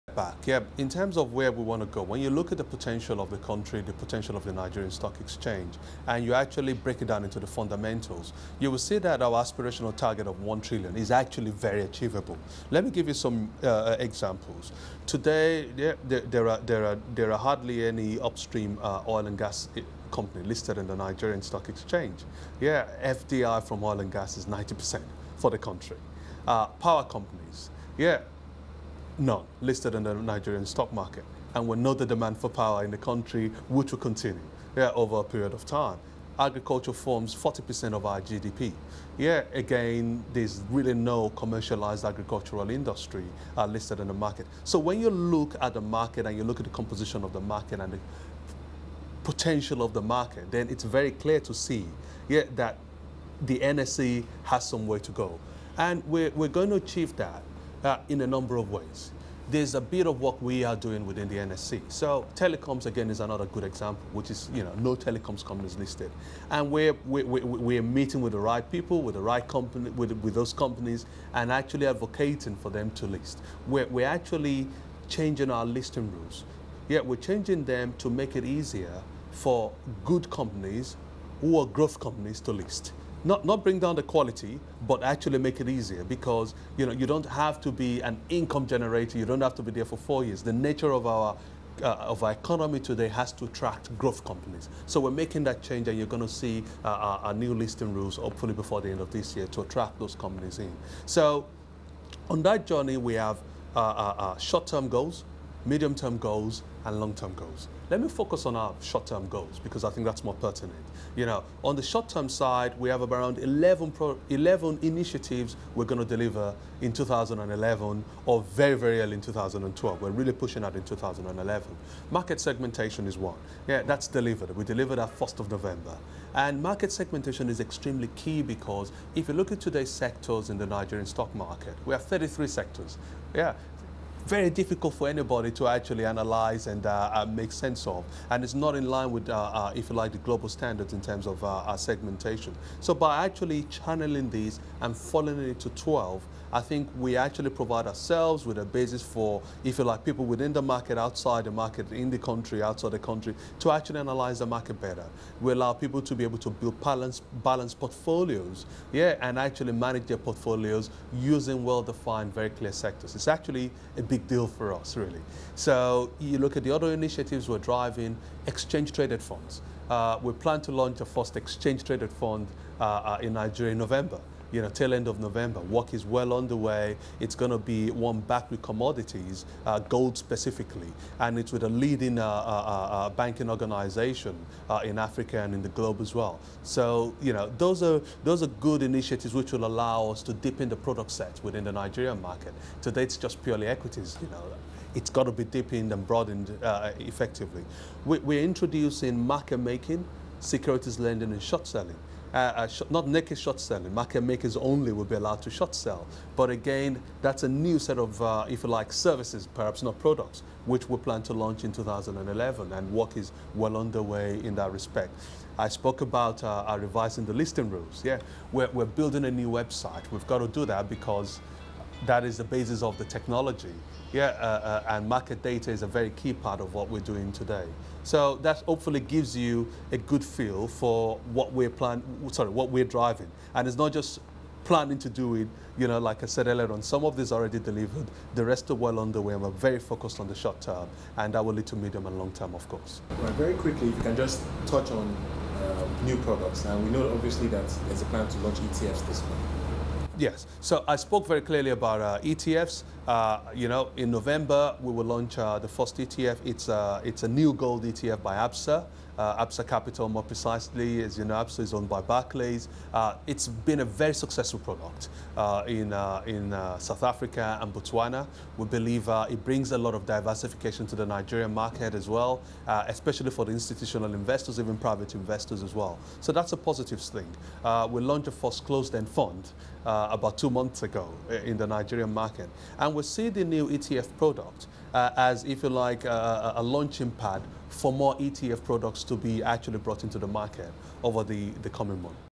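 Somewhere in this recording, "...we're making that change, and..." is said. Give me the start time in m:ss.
1:34.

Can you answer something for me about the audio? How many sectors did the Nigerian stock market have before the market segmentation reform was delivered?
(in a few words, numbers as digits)
33.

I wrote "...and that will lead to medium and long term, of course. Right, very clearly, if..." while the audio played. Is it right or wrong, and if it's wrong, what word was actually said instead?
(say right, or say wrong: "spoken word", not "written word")
wrong: "quickly", not "clearly".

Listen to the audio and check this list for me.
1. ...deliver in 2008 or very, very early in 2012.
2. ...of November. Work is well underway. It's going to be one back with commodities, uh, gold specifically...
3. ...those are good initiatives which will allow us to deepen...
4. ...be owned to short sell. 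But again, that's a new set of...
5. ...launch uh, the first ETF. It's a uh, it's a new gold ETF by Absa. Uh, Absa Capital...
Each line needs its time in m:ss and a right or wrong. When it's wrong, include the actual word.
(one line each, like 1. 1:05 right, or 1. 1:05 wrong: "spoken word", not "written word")
1. 1:56 wrong: "2011", not "2008"
2. 2:55 right
3. 3:08 right
4. 3:25 wrong: "allowed", not "owned"
5. 4:15 right.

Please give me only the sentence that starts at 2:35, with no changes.
We allow people to be able to build balanced balance portfolios, yeah, and actually manage their portfolios using well-defined, very clear sectors.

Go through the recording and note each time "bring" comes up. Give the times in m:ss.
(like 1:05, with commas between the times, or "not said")
1:23, 4:29.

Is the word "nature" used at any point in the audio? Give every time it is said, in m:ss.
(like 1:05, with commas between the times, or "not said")
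1:30.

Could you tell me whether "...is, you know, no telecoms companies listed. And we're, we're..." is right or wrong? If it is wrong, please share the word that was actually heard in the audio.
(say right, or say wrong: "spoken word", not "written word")
right.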